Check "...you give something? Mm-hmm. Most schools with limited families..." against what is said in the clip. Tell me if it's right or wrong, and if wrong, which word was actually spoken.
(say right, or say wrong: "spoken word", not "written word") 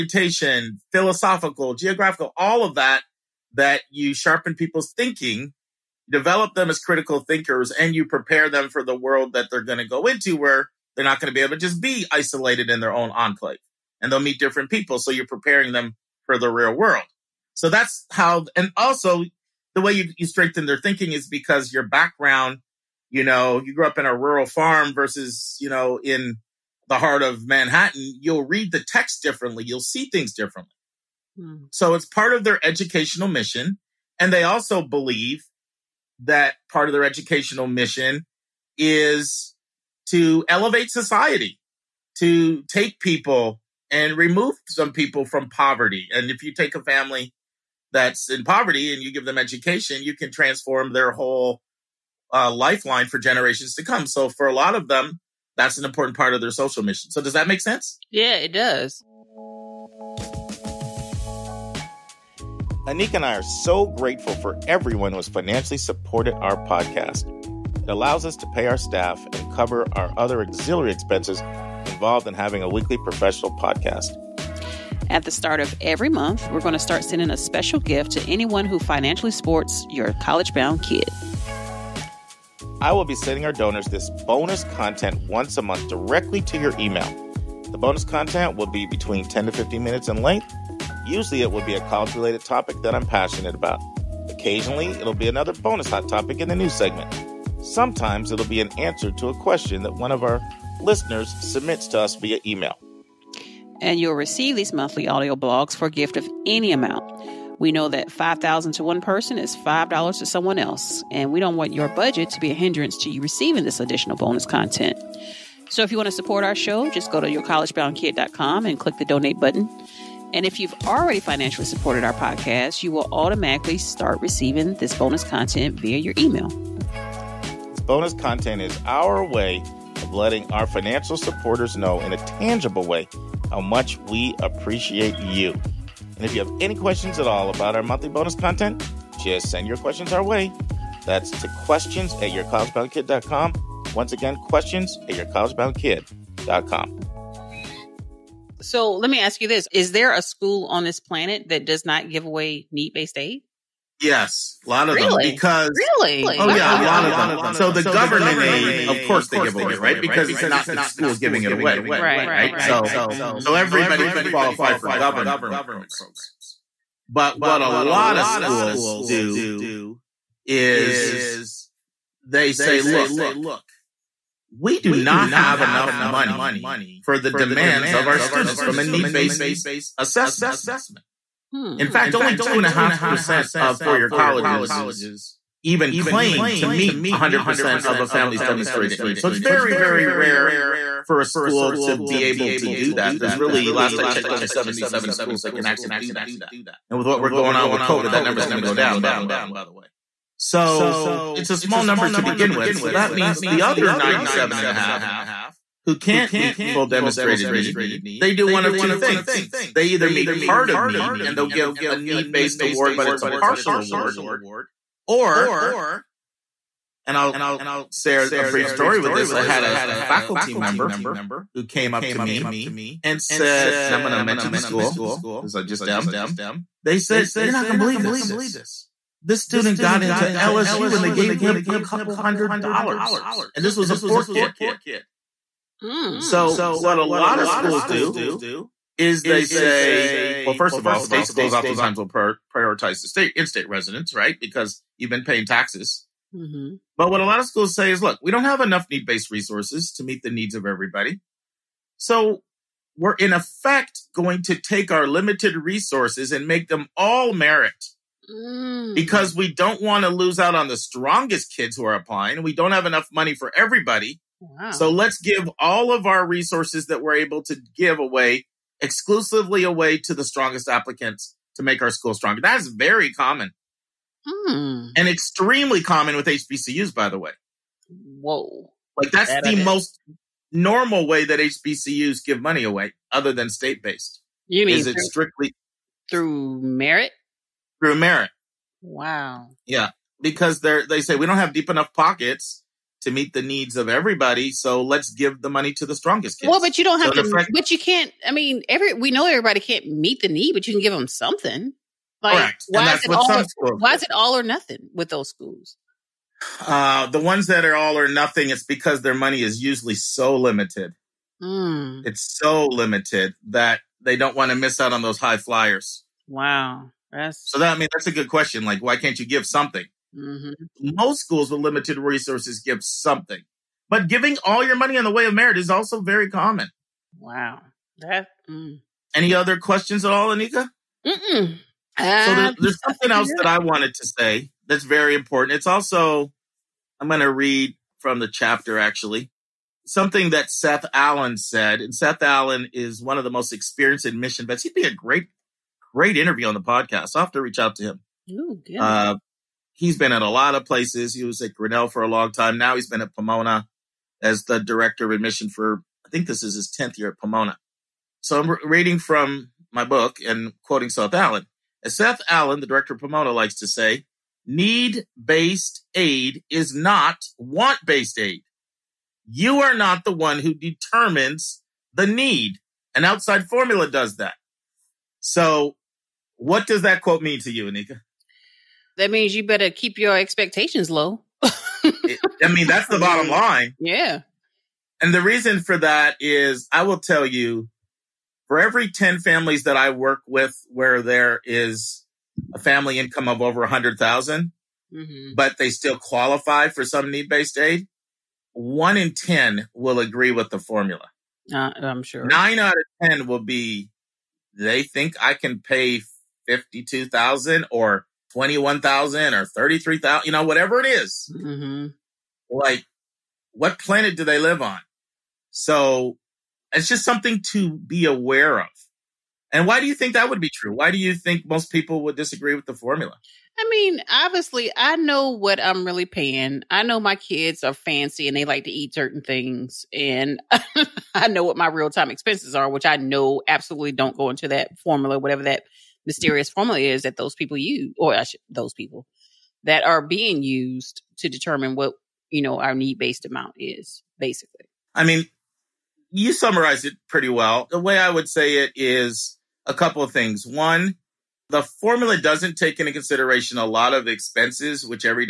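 wrong: "resources", not "families".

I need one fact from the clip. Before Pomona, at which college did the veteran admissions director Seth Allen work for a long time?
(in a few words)
Grinnell.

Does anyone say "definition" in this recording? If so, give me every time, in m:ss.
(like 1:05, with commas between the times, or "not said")
not said.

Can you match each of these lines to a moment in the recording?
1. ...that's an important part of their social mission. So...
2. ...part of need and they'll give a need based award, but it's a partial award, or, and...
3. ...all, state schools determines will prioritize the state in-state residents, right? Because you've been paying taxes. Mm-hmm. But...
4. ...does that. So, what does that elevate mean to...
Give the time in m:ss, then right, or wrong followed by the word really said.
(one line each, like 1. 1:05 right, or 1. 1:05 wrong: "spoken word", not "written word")
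1. 0:55 right
2. 3:30 right
3. 4:00 wrong: "oftentimes", not "determines"
4. 6:13 wrong: "quote", not "elevate".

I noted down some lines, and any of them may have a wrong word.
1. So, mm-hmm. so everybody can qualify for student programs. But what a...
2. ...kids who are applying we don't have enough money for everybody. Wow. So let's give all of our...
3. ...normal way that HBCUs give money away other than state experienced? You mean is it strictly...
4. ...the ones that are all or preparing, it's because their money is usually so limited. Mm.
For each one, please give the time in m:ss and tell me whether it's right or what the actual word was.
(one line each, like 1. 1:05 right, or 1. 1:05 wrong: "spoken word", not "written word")
1. 2:42 wrong: "government", not "student"
2. 4:21 right
3. 4:40 wrong: "based", not "experienced"
4. 5:07 wrong: "nothing", not "preparing".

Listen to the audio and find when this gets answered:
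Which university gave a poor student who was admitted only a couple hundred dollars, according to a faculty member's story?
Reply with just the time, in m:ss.
3:50.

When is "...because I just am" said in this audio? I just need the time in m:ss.
3:45.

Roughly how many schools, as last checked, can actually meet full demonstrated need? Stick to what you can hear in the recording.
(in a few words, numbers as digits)
77.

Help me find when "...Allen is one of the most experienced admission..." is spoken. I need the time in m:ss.
5:42.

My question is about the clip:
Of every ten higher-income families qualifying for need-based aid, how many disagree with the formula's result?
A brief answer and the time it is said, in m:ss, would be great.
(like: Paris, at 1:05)
9, at 6:42.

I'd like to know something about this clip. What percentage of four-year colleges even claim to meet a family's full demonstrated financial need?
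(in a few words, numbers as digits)
2.5%.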